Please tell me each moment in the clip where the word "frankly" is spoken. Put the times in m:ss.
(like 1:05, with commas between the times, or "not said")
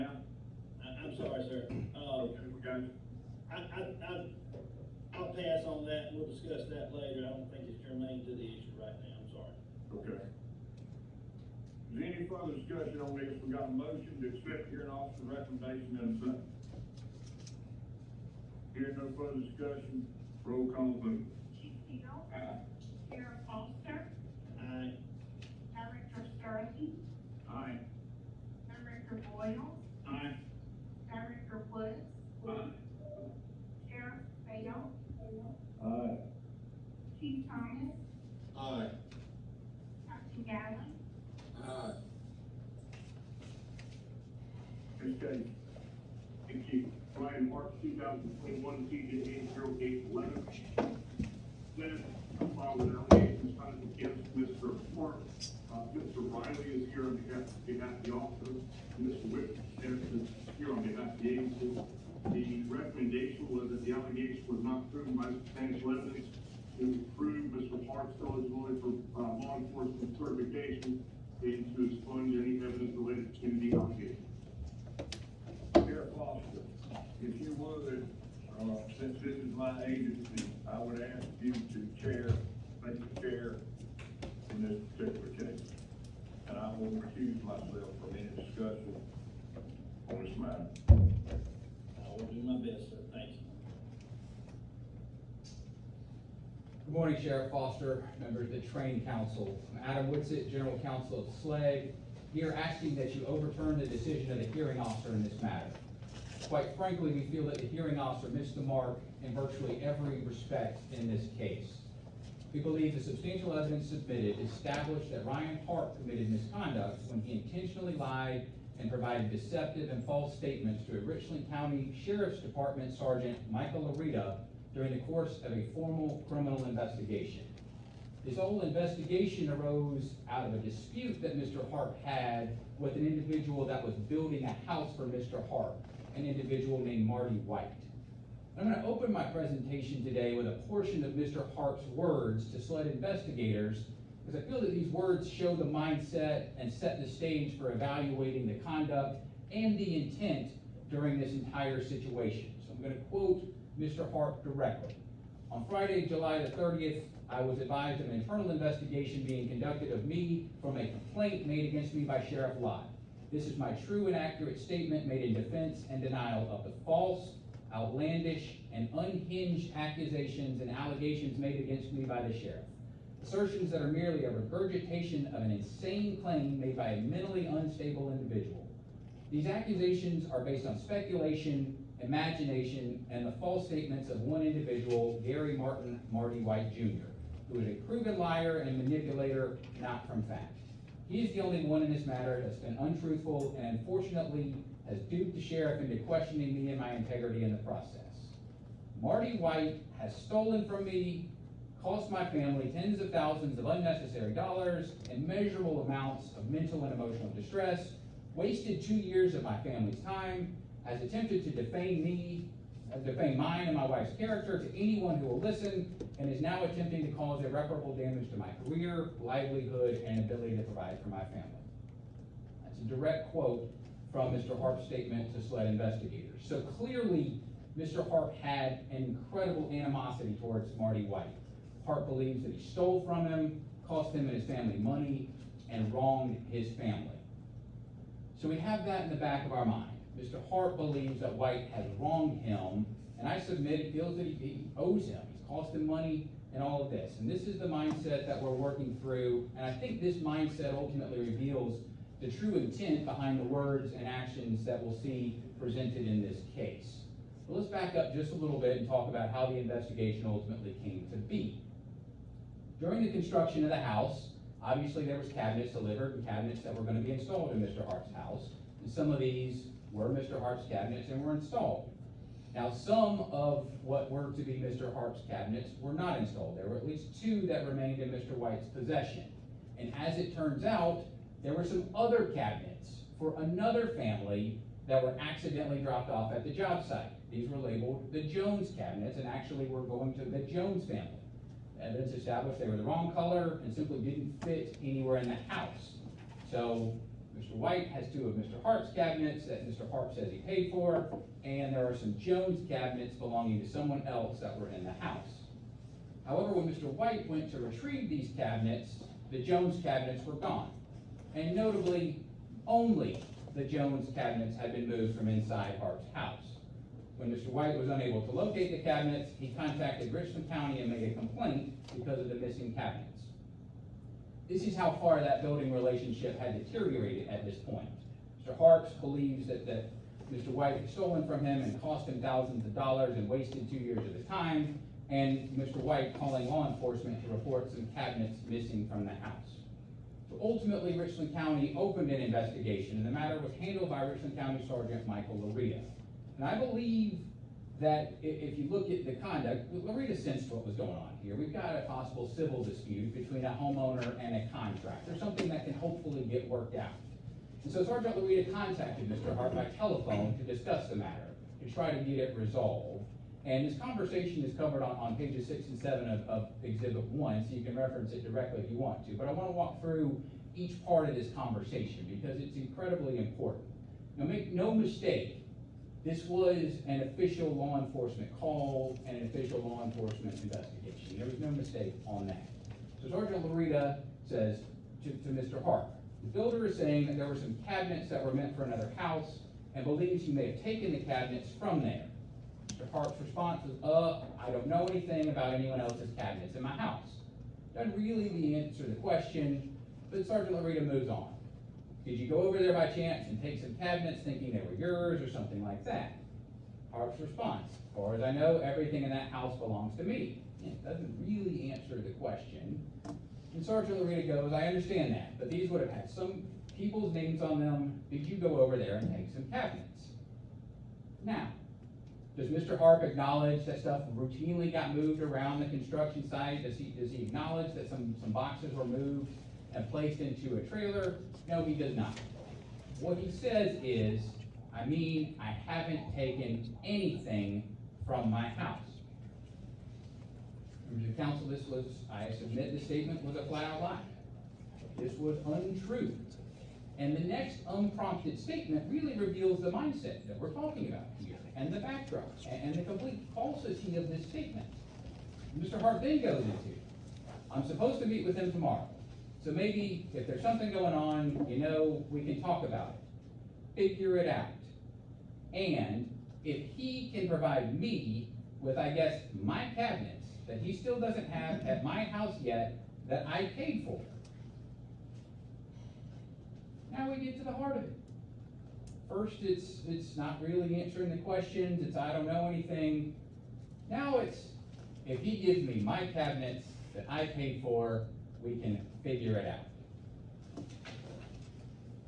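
1:46.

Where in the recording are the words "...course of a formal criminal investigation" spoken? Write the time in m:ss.
2:04.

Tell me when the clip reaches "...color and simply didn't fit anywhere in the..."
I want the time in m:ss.
4:53.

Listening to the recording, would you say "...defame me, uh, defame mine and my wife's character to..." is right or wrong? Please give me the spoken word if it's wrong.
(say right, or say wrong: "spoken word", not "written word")
right.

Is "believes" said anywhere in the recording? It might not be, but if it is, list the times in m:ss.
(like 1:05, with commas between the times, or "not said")
1:52, 3:52, 4:00, 5:28, 5:46, 6:29.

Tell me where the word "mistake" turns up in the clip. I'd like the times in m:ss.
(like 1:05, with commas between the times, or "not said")
6:14, 6:21.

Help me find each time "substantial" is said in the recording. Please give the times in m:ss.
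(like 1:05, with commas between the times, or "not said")
1:05, 1:53.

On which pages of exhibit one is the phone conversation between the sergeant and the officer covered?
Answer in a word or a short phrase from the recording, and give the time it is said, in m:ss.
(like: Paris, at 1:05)
6 and 7, at 6:05.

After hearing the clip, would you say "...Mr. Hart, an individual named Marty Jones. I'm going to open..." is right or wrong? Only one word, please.
wrong.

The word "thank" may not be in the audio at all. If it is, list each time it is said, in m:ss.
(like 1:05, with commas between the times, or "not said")
0:46, 1:22, 1:33.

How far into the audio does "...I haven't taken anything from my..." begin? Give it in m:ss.
7:15.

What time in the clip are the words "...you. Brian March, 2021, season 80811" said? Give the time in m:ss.
0:46.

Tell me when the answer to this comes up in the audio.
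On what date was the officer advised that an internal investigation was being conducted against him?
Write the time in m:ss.
2:36.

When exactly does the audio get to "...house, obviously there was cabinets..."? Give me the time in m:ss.
4:23.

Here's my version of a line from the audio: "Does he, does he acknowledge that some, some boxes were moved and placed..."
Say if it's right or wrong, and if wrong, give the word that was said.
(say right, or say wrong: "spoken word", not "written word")
right.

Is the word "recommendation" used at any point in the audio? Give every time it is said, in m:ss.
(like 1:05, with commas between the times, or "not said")
0:15, 1:02.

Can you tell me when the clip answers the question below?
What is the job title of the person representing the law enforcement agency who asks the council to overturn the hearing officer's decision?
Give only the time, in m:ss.
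1:40.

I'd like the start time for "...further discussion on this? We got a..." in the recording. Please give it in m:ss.
0:12.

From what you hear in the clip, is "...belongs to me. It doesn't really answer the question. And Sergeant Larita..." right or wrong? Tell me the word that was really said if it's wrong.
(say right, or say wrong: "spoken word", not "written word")
right.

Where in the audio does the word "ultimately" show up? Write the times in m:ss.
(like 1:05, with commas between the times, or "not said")
4:10, 4:20, 5:40.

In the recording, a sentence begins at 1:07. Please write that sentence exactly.
Park's eligibility for uh, law enforcement certification and to expunge any evidence related to the allegation.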